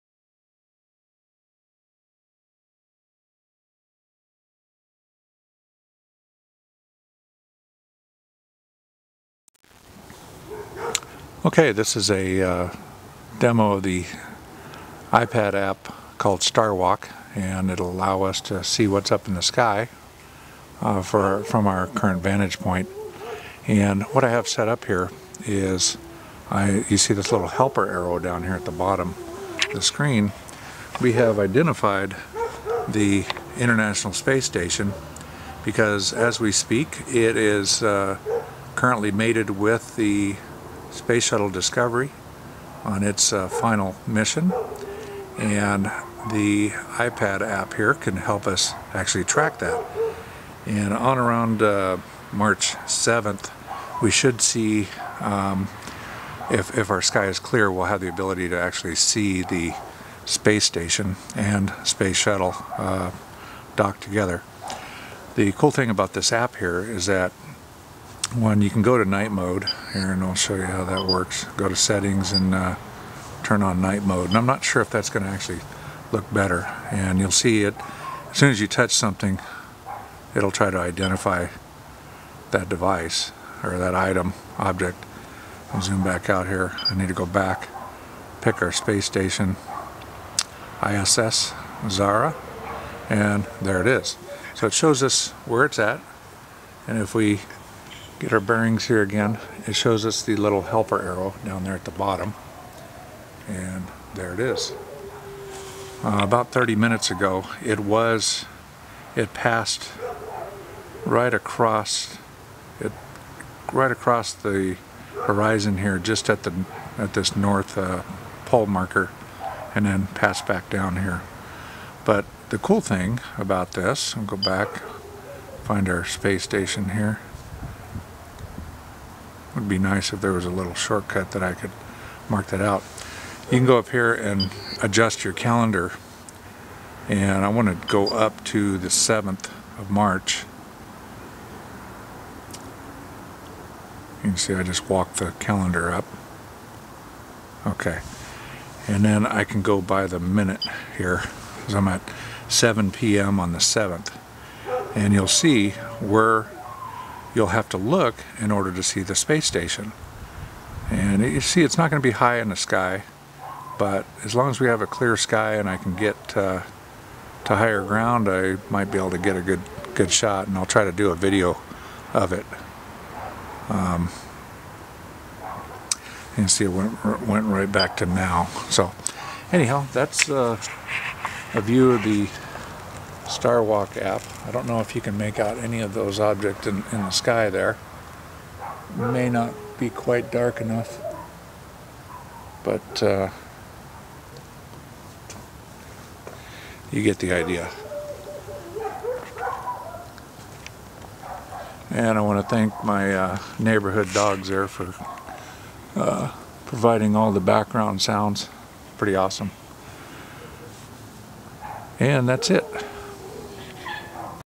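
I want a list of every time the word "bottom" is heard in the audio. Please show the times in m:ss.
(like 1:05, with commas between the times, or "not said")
0:28, 1:41.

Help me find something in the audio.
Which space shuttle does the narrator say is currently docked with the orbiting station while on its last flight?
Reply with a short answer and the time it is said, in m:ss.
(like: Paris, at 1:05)
Discovery, at 0:41.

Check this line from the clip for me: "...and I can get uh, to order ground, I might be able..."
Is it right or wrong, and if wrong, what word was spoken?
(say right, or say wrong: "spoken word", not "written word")
wrong: "higher", not "order".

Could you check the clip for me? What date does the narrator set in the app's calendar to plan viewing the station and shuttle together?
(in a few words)
March 7.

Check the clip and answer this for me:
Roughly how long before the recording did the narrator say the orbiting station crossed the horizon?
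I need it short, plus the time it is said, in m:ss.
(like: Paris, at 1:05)
30 minutes, at 1:46.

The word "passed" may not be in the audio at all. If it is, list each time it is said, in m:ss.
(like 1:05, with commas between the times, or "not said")
1:49, 2:00.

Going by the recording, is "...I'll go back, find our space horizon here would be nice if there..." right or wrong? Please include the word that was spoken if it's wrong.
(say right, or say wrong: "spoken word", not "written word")
wrong: "station", not "horizon".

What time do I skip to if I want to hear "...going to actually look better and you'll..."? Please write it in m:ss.
1:15.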